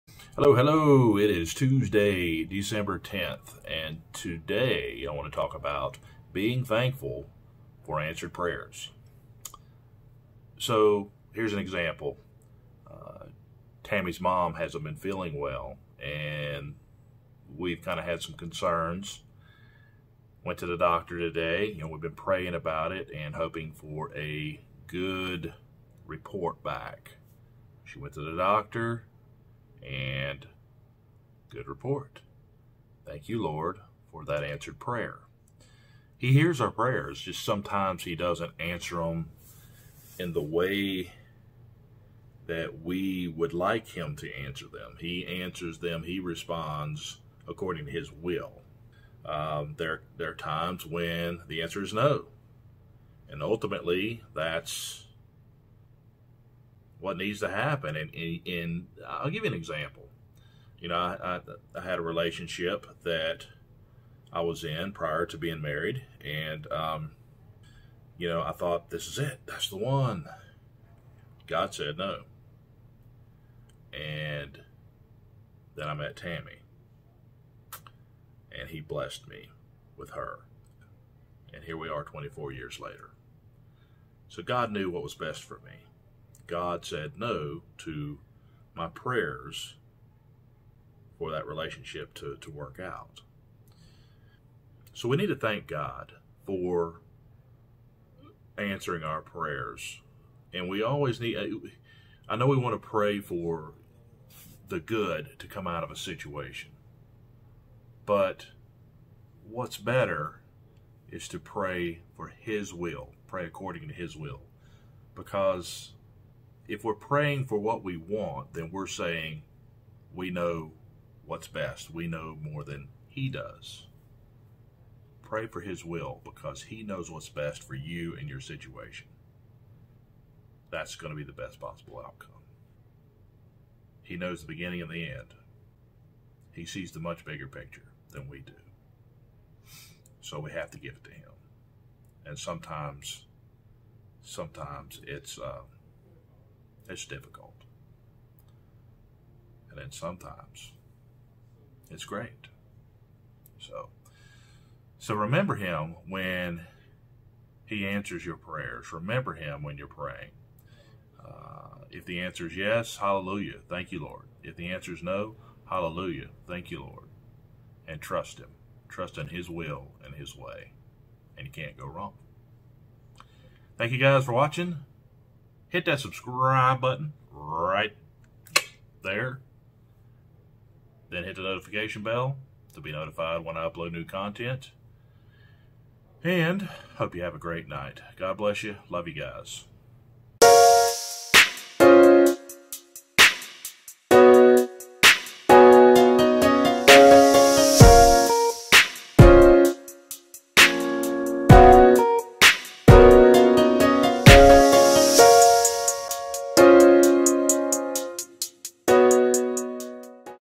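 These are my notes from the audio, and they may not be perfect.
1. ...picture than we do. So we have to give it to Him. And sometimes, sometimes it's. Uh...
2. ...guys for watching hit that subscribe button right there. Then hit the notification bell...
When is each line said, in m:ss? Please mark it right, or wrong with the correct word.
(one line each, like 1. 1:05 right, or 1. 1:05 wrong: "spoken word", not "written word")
1. 2:17 right
2. 2:53 right.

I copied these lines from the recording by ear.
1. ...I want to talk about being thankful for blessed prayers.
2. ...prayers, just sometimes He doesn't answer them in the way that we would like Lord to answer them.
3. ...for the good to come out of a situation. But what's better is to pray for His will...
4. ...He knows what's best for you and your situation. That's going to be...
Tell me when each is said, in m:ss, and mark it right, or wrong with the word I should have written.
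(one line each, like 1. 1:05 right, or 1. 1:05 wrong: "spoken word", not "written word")
1. 0:05 wrong: "answered", not "blessed"
2. 0:36 wrong: "Him", not "Lord"
3. 1:43 right
4. 2:06 right.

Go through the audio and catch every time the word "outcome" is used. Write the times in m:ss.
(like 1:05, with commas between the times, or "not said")
2:12.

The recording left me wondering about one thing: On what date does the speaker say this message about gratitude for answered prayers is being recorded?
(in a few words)
Tuesday, December 10th.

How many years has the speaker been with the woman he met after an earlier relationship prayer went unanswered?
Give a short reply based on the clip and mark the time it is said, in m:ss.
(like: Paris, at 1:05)
24, at 1:22.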